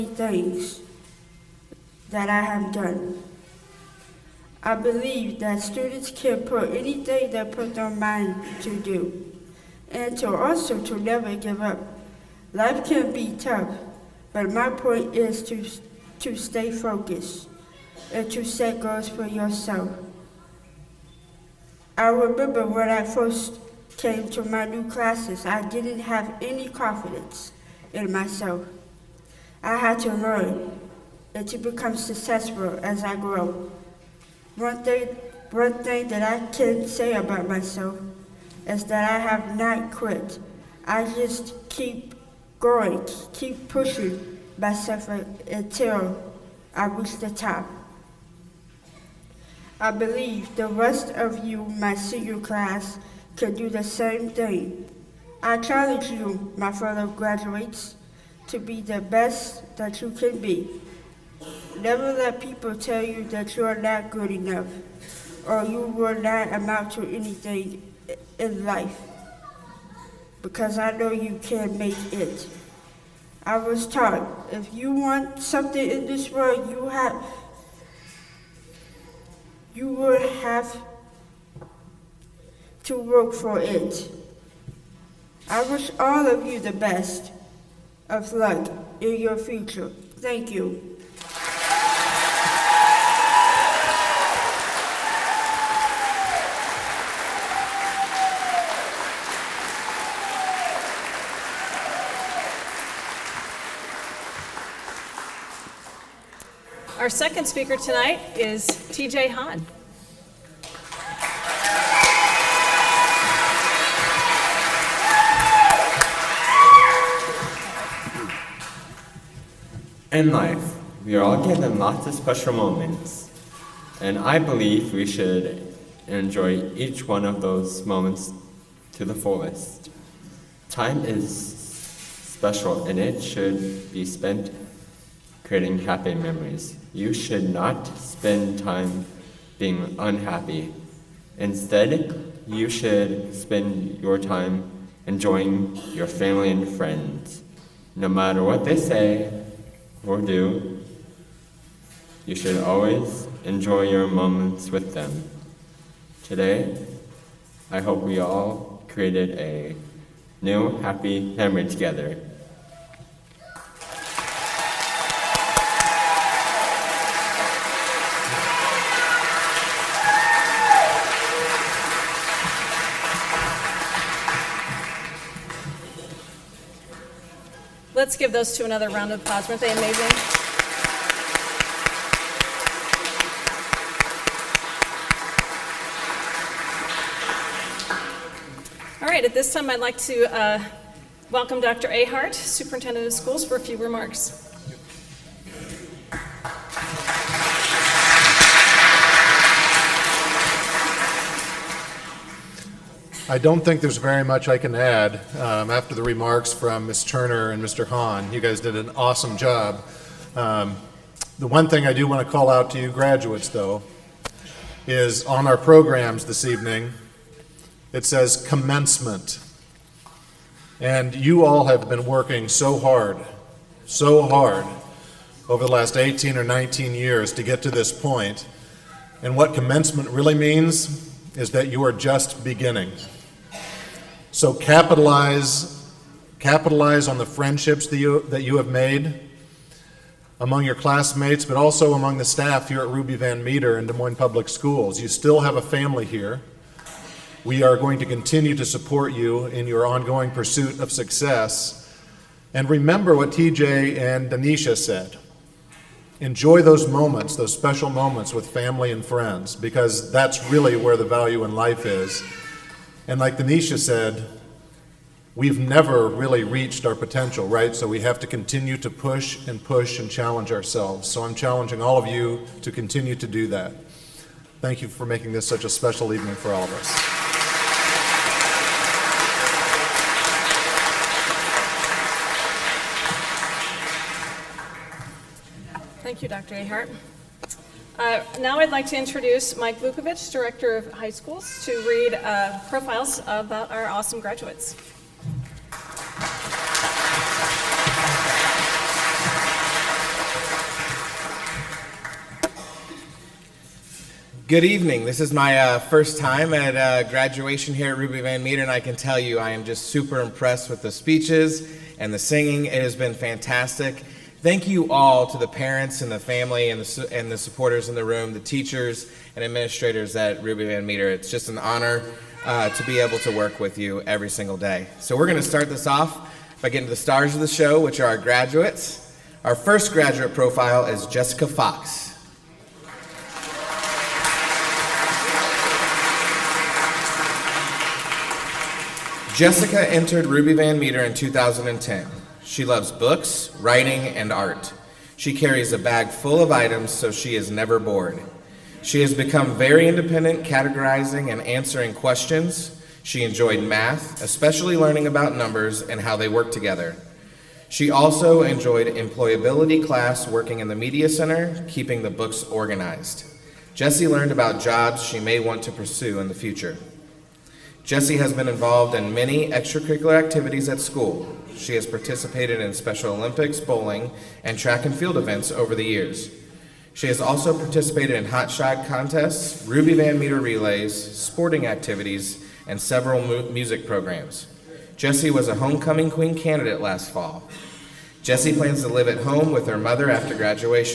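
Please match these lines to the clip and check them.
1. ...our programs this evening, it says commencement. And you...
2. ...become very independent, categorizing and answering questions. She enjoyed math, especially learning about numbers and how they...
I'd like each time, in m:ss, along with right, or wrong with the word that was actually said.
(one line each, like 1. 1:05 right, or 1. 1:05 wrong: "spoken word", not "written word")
1. 3:35 right
2. 5:49 right.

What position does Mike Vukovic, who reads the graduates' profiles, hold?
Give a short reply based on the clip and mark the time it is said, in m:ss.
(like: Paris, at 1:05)
Director of High Schools, at 4:50.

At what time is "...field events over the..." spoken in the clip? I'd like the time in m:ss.
6:14.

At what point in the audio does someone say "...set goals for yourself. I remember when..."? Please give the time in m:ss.
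0:18.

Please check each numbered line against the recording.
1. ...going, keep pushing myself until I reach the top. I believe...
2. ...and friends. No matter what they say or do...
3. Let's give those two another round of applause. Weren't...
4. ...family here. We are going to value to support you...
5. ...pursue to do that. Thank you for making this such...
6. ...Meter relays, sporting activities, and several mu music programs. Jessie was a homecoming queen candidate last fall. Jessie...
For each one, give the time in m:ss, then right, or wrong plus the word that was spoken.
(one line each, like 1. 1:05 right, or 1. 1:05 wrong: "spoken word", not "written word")
1. 0:42 right
2. 2:26 right
3. 2:58 right
4. 4:05 wrong: "continue", not "value"
5. 4:32 wrong: "continue", not "pursue"
6. 6:20 right.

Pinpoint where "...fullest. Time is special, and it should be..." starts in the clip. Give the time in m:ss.
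2:09.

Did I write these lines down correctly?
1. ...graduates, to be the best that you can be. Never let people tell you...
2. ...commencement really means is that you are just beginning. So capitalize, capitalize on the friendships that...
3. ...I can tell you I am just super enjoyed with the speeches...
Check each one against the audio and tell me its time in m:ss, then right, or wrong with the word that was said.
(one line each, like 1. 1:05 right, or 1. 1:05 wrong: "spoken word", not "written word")
1. 0:57 right
2. 3:49 right
3. 5:08 wrong: "impressed", not "enjoyed".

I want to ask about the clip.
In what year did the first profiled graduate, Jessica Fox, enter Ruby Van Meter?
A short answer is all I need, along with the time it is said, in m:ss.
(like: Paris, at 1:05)
2010, at 5:41.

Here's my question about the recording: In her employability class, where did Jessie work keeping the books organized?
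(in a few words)
media center.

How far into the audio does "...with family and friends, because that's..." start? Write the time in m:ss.
4:18.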